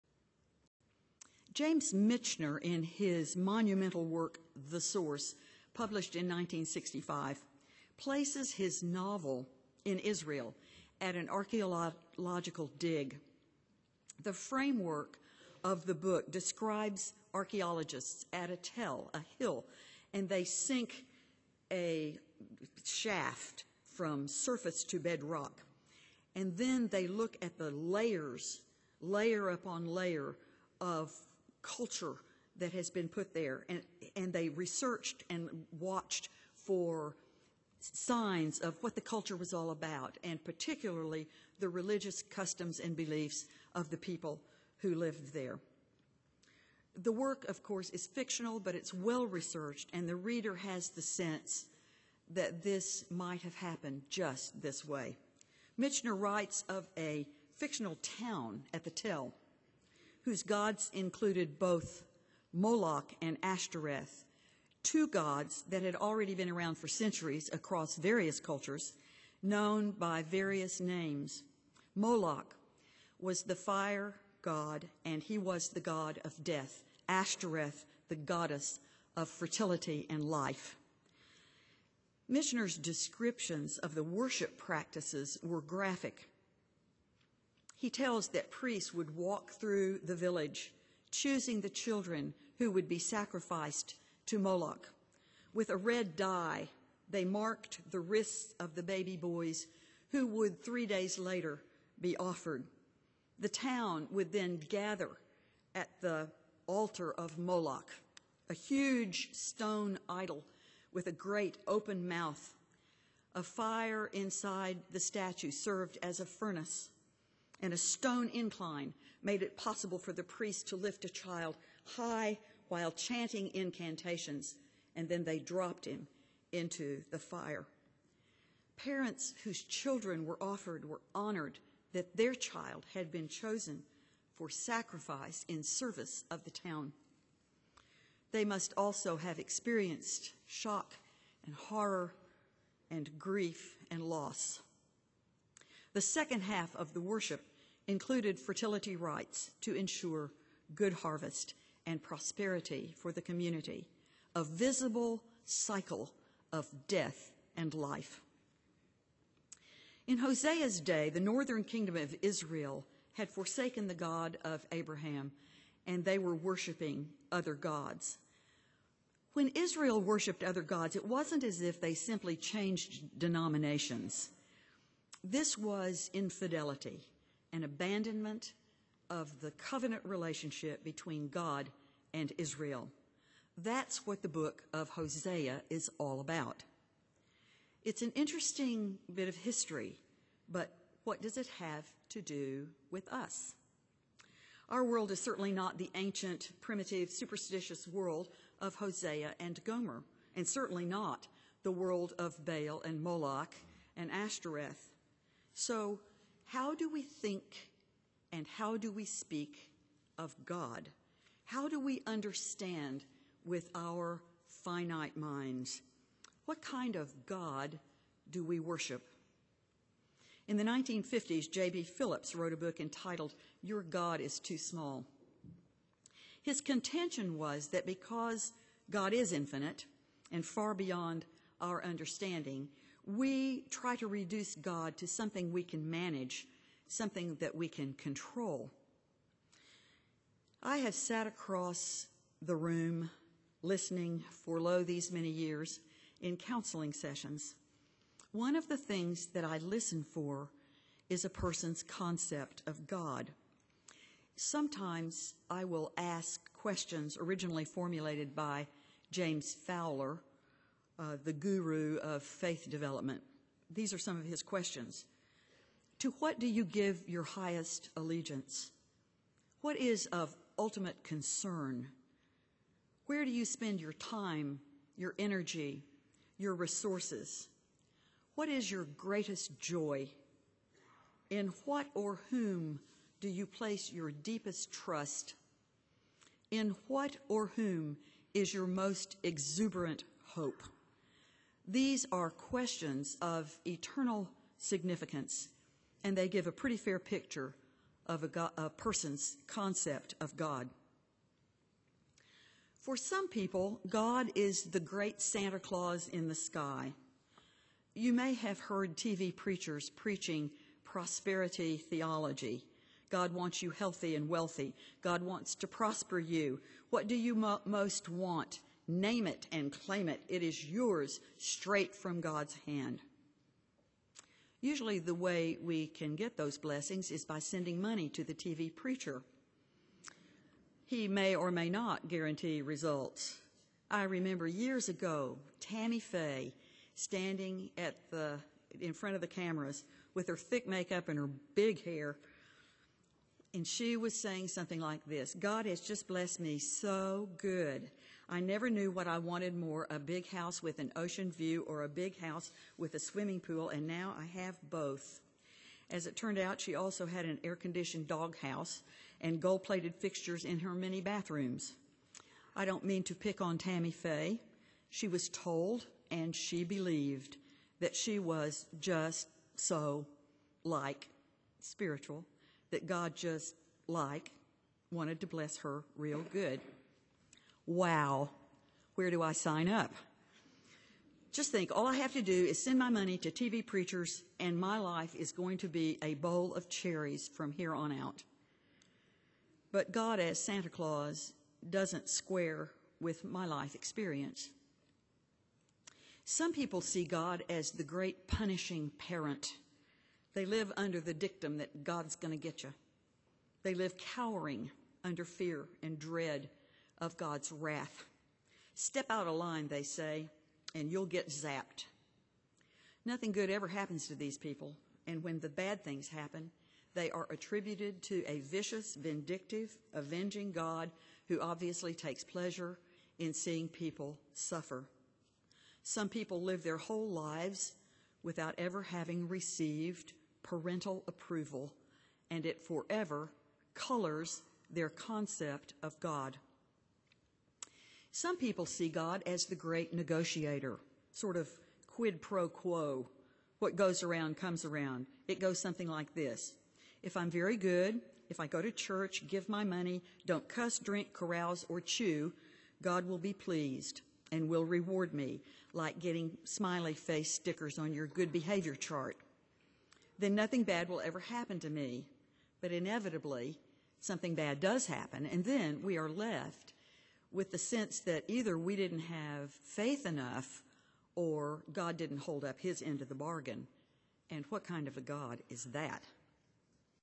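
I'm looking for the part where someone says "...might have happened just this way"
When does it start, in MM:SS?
00:53.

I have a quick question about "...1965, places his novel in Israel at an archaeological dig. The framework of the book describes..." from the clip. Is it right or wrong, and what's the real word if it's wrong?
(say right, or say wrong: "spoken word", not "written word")
right.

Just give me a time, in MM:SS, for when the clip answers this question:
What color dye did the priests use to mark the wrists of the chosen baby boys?
01:35.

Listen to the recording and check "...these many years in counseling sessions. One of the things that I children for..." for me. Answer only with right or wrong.
wrong.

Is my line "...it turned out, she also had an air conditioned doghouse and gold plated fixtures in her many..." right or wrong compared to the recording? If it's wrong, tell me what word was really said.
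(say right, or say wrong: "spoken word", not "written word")
right.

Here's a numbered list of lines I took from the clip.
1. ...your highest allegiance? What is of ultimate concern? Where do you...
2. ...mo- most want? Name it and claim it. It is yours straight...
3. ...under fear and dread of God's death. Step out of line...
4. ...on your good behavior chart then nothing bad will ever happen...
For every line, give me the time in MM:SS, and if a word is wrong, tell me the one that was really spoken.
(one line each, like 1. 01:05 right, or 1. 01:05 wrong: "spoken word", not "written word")
1. 04:27 right
2. 05:17 right
3. 06:45 wrong: "wrath", not "death"
4. 07:37 right.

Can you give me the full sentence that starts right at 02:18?
They must also have experienced shock and horror and grief and loss.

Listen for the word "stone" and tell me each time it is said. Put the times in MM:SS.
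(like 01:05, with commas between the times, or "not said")
01:49, 01:57.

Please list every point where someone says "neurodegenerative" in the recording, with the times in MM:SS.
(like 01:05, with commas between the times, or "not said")
not said.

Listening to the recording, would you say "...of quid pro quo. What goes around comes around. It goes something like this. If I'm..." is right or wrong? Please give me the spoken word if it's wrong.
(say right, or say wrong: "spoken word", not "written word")
right.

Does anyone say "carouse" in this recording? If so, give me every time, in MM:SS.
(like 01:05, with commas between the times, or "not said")
07:31.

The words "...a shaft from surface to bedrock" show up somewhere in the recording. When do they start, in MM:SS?
00:21.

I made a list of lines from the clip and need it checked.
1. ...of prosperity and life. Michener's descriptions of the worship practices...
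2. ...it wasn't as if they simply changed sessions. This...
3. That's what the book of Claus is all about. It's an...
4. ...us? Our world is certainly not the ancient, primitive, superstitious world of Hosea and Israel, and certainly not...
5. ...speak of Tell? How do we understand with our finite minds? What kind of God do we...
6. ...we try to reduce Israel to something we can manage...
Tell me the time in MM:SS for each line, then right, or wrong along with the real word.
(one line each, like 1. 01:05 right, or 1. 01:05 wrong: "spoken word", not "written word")
1. 01:19 wrong: "fertility", not "prosperity"
2. 02:50 wrong: "denominations", not "sessions"
3. 03:03 wrong: "Hosea", not "Claus"
4. 03:13 wrong: "Gomer", not "Israel"
5. 03:29 wrong: "God", not "Tell"
6. 03:53 wrong: "God", not "Israel".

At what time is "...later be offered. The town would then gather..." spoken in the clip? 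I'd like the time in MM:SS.
01:41.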